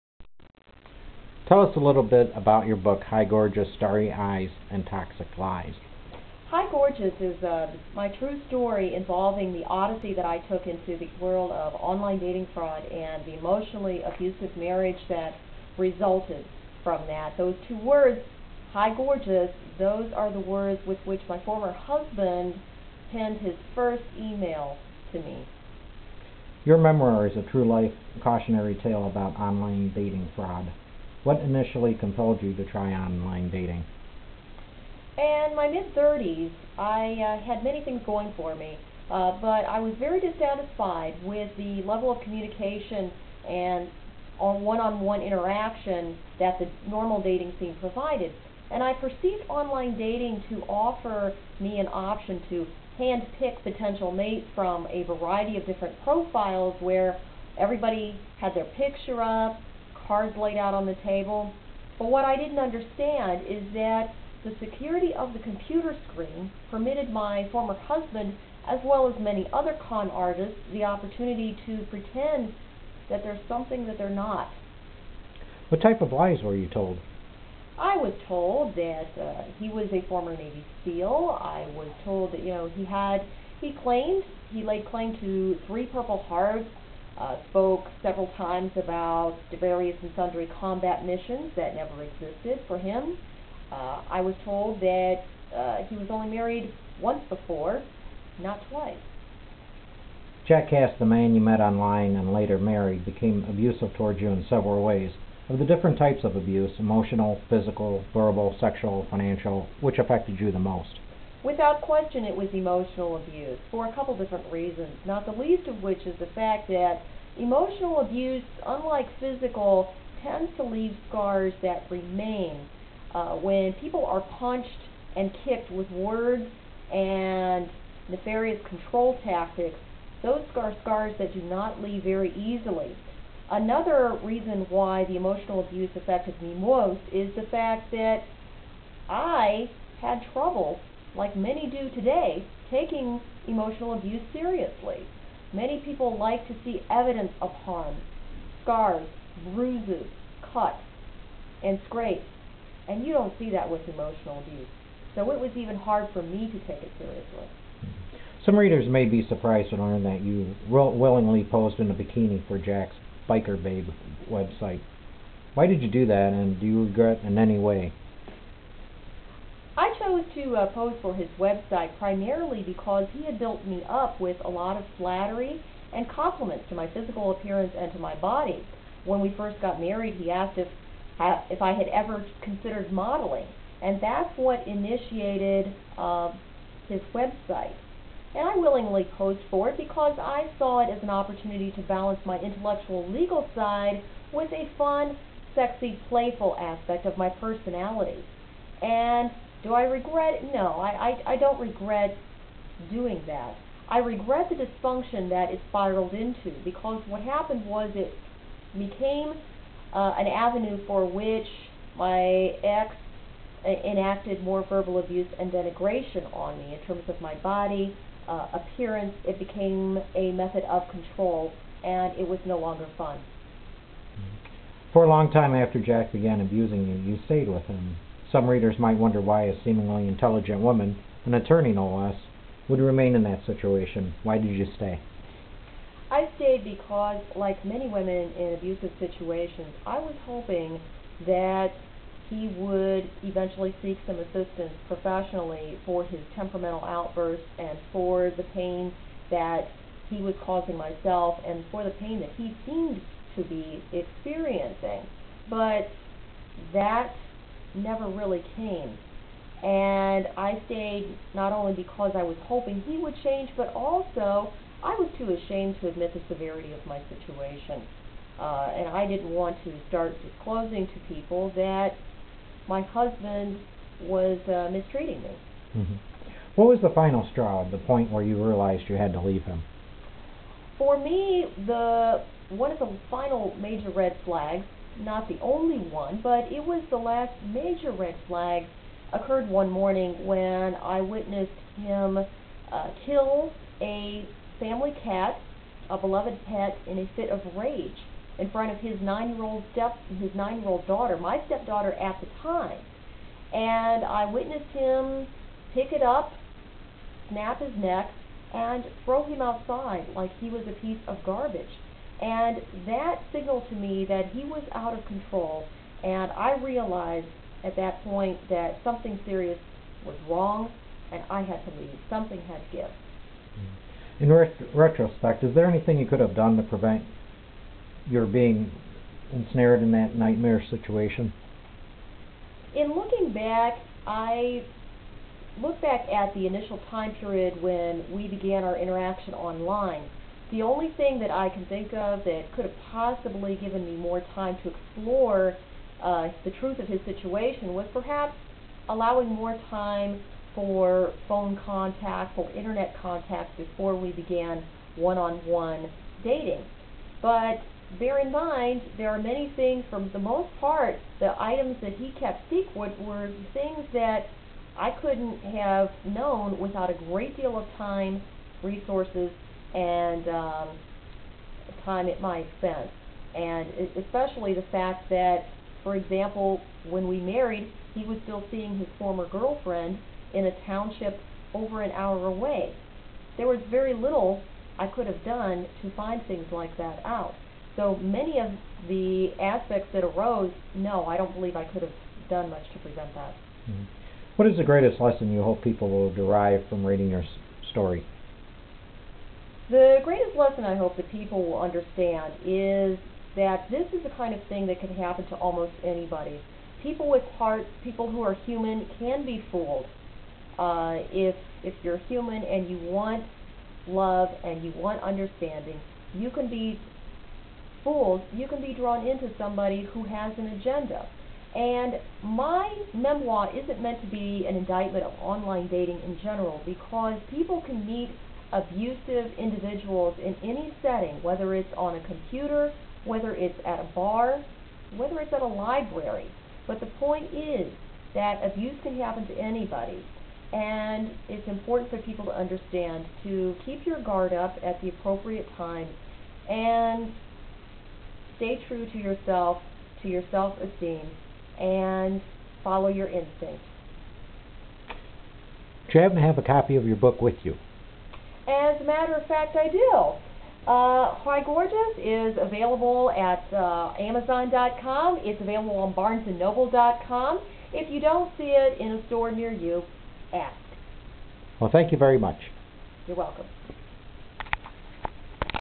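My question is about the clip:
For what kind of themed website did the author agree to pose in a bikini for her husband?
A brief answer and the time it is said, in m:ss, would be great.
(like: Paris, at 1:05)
Biker Babe, at 2:43.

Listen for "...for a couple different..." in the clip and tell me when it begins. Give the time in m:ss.
1:53.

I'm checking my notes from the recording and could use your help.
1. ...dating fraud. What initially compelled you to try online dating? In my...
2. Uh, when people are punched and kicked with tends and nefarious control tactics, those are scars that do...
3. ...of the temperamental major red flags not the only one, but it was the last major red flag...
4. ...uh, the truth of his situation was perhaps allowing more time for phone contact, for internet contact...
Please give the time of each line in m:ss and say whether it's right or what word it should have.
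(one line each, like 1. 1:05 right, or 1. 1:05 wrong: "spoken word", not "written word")
1. 0:29 right
2. 2:03 wrong: "words", not "tends"
3. 4:42 wrong: "final", not "temperamental"
4. 5:46 right.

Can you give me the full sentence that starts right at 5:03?
And I witnessed him pick it up, snap his neck, and throw him outside like he was a piece of garbage.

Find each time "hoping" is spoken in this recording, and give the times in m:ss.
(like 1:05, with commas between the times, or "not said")
4:00, 4:22.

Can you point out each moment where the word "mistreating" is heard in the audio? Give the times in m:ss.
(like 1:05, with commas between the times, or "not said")
4:34.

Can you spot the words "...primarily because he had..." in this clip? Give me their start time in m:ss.
2:51.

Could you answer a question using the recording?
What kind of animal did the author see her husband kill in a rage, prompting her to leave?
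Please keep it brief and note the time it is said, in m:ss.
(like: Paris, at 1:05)
cat, at 4:55.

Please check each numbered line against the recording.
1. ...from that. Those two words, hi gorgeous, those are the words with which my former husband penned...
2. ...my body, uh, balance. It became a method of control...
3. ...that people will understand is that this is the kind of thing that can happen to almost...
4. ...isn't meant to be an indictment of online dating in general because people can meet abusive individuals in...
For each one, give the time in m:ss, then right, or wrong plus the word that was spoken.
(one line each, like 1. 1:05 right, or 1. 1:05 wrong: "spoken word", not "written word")
1. 0:16 right
2. 3:37 wrong: "appearance", not "balance"
3. 6:40 right
4. 7:03 right.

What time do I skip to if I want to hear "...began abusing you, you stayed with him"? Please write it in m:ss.
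3:46.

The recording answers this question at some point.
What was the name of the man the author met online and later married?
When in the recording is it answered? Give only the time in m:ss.
1:40.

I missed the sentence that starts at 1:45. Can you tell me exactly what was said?
Of the different types of abuse, emotional, physical, verbal, sexual, financial, which affected you the most?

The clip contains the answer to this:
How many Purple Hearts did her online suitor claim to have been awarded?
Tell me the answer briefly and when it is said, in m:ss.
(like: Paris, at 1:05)
3, at 1:25.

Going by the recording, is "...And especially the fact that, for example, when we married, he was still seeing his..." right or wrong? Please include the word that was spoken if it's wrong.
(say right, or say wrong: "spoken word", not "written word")
right.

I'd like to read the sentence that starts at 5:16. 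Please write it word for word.
And I realized at that point that something serious was wrong and I had to leave.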